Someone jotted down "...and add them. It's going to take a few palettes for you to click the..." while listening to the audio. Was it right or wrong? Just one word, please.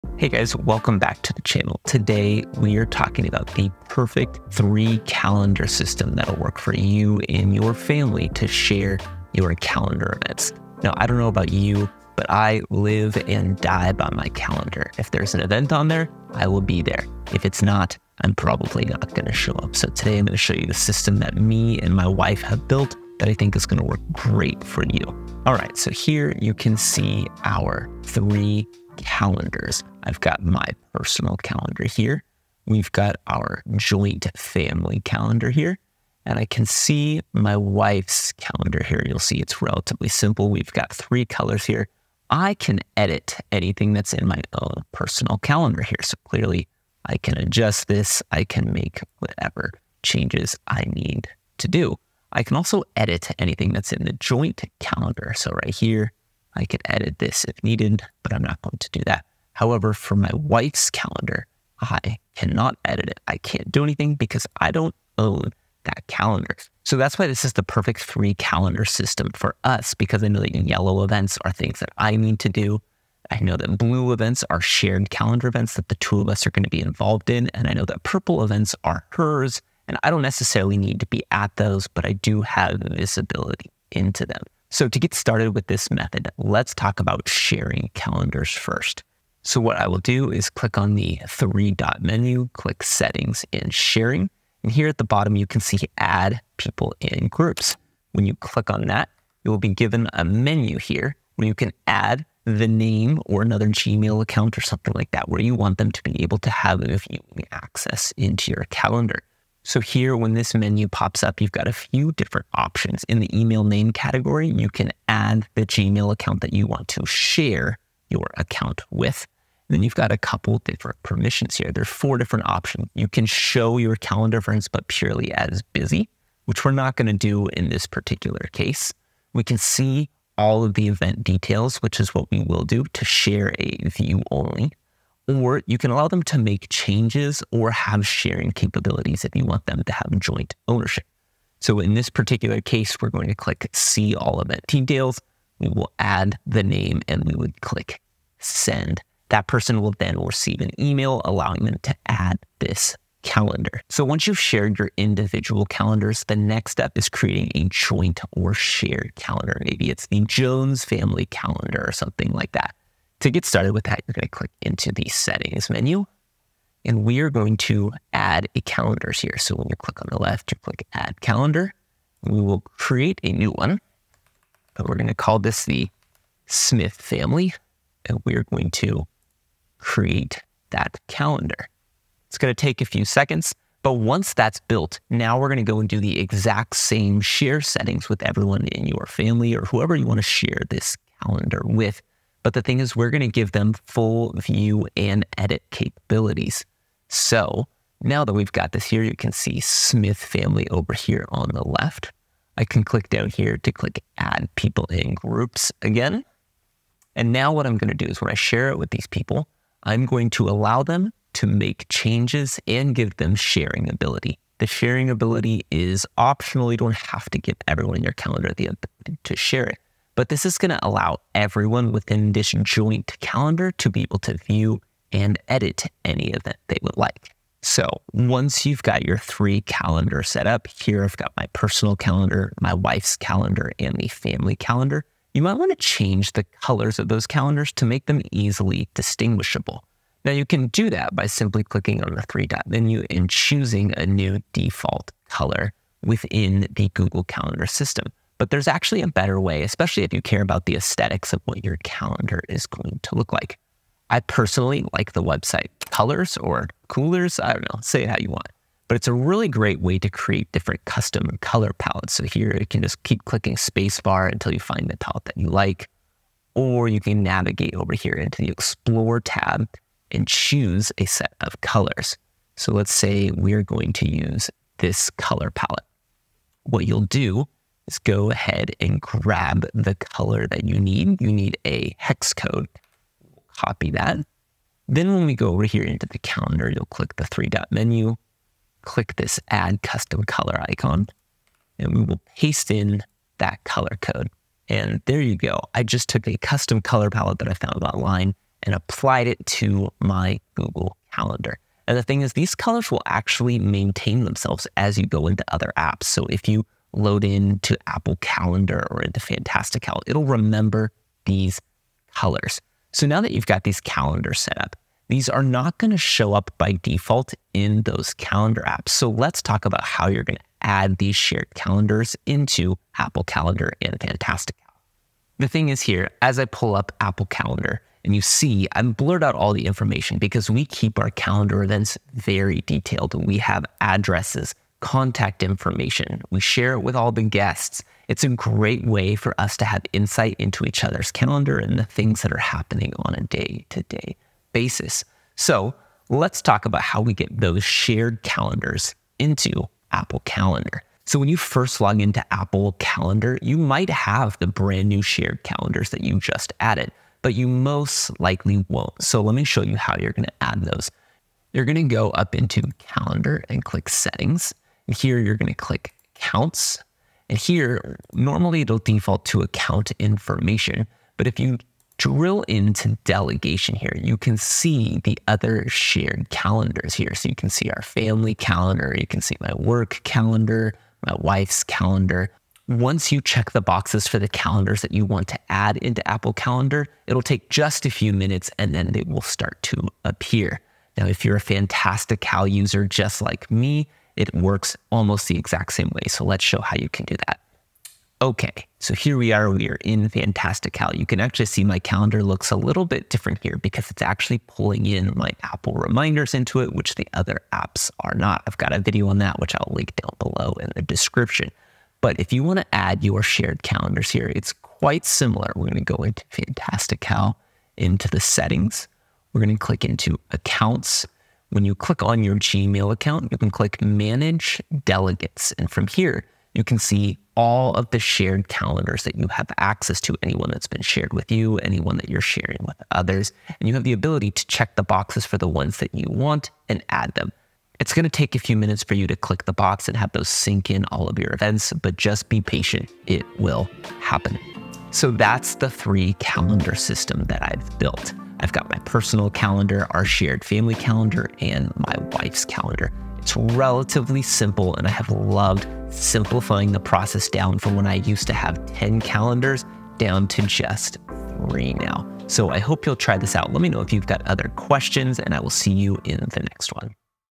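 wrong.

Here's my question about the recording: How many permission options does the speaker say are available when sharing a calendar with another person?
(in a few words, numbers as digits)
4.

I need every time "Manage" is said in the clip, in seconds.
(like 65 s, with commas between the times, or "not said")
423 s.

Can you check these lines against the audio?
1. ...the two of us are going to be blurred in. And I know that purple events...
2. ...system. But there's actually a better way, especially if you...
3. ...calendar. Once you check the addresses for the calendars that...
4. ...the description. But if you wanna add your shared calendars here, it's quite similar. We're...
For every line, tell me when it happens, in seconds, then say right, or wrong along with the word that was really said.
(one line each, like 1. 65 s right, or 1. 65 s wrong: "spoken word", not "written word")
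1. 75 s wrong: "involved", not "blurred"
2. 247 s right
3. 381 s wrong: "boxes", not "addresses"
4. 410 s right.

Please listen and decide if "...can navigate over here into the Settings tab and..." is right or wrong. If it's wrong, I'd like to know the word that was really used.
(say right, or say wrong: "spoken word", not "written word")
wrong: "Explore", not "Settings".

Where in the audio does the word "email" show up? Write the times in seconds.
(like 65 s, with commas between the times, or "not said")
113 s, 150 s.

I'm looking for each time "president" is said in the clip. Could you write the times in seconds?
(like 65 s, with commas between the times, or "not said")
not said.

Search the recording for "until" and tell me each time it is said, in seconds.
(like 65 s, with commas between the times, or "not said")
264 s.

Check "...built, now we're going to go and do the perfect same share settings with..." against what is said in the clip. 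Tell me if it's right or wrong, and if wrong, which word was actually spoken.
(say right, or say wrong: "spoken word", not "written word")
wrong: "exact", not "perfect".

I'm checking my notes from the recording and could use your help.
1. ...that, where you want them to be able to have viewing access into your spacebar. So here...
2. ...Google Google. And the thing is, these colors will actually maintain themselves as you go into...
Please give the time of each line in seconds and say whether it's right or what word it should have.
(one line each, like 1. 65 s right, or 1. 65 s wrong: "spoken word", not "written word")
1. 105 s wrong: "calendar", not "spacebar"
2. 300 s wrong: "Calendar", not "Google".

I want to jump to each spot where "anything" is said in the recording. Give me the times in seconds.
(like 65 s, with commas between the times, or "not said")
43 s, 53 s, 63 s.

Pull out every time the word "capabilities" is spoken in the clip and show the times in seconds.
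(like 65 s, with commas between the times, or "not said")
138 s, 195 s.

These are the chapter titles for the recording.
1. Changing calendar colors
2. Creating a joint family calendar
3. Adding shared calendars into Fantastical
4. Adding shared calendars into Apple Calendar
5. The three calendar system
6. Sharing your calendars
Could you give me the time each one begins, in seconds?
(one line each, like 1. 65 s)
1. 227 s
2. 154 s
3. 398 s
4. 325 s
5. 25 s
6. 85 s.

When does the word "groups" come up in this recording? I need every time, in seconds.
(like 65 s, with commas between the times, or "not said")
97 s, 205 s.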